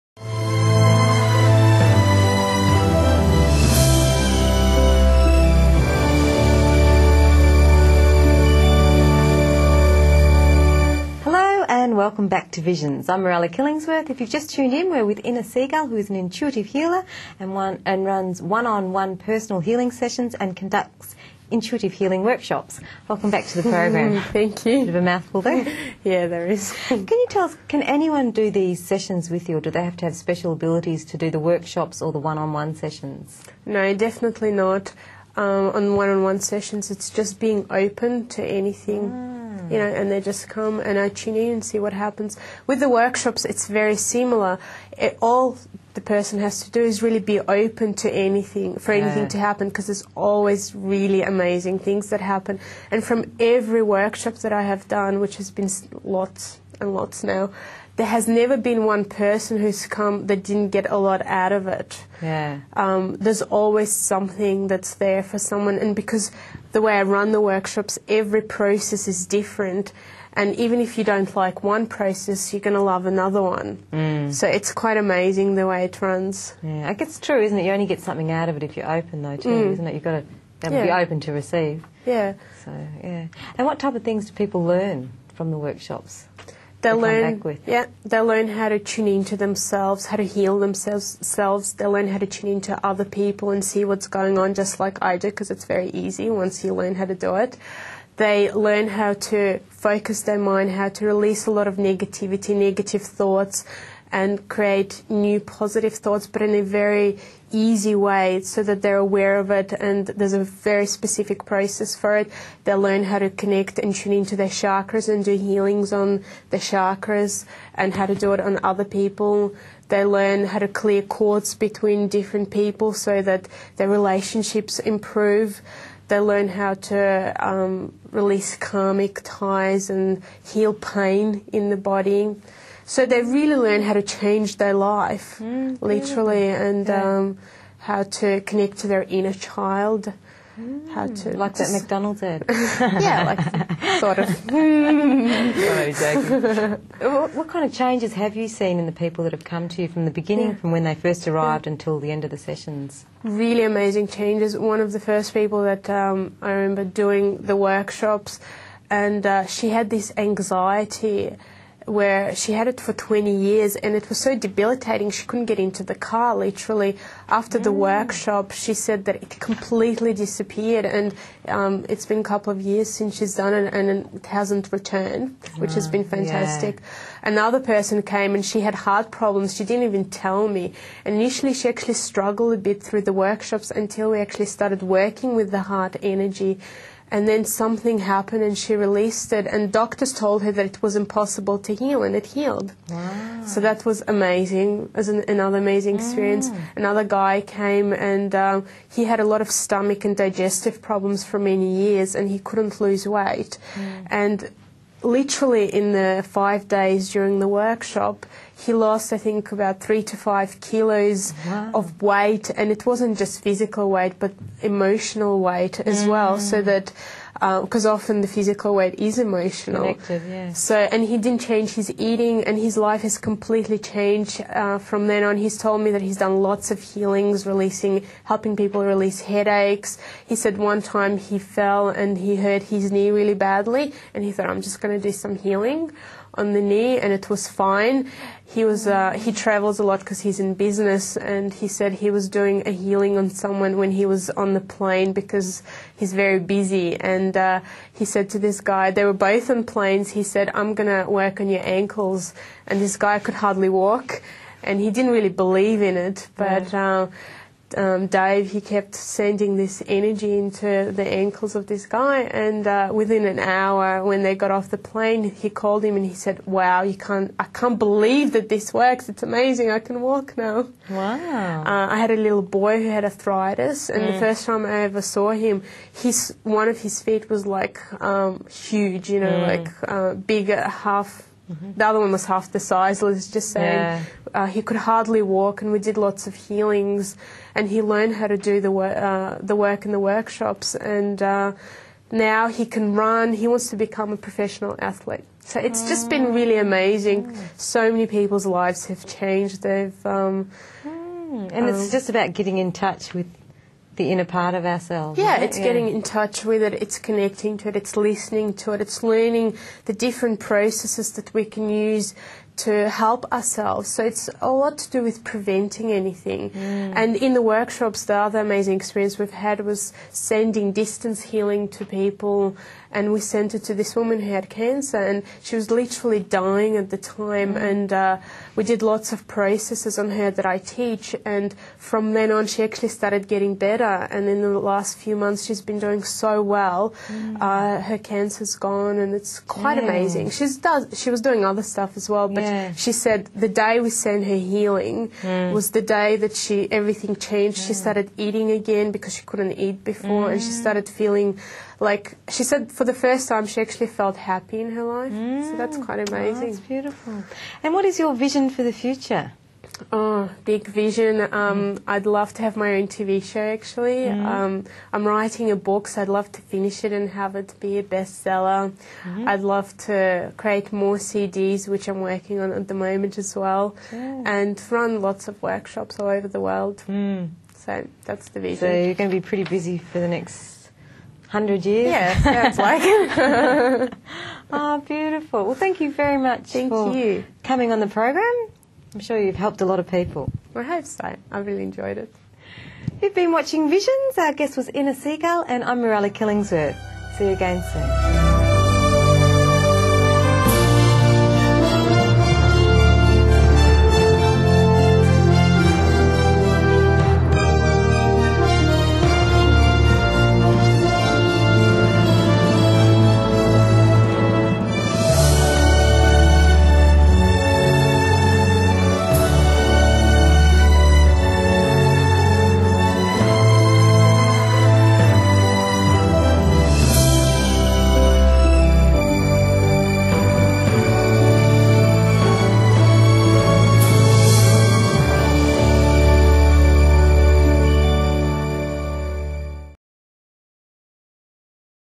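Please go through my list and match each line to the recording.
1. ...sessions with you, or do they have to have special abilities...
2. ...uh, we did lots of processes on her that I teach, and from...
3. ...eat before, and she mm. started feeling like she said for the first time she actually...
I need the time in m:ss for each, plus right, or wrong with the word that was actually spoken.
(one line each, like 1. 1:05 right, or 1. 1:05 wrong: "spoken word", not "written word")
1. 0:28 right
2. 5:27 right
3. 5:49 right.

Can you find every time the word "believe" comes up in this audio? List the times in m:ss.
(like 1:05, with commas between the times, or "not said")
4:15, 4:27.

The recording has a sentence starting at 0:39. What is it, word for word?
Mm you know, and they just come and I tune in and see what happens.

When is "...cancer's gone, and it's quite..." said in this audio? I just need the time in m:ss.
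5:37.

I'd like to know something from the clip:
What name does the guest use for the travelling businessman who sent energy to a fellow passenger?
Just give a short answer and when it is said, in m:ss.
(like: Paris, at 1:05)
Dave, at 4:18.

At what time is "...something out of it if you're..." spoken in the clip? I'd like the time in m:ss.
1:17.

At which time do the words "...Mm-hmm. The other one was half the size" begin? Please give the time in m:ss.
4:41.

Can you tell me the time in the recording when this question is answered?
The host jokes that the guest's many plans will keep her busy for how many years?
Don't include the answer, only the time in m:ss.
6:21.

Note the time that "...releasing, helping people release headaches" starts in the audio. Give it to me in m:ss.
3:47.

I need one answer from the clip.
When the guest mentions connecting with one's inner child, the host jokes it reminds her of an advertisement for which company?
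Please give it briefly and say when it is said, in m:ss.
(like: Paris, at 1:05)
McDonald's, at 2:21.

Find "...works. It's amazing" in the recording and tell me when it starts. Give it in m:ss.
4:28.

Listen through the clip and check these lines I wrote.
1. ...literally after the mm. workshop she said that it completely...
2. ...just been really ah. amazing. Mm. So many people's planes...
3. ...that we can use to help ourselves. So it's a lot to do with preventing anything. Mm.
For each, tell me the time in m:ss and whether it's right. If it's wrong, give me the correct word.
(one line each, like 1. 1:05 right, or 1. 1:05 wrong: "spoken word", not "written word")
1. 2:46 right
2. 4:55 wrong: "lives", not "planes"
3. 5:11 right.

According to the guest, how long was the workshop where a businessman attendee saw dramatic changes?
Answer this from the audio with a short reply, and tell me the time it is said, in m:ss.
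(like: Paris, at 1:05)
5 days, at 3:26.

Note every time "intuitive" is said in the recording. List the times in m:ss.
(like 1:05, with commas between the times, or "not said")
0:16, 0:21.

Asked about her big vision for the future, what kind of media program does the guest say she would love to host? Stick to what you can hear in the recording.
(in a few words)
TV show.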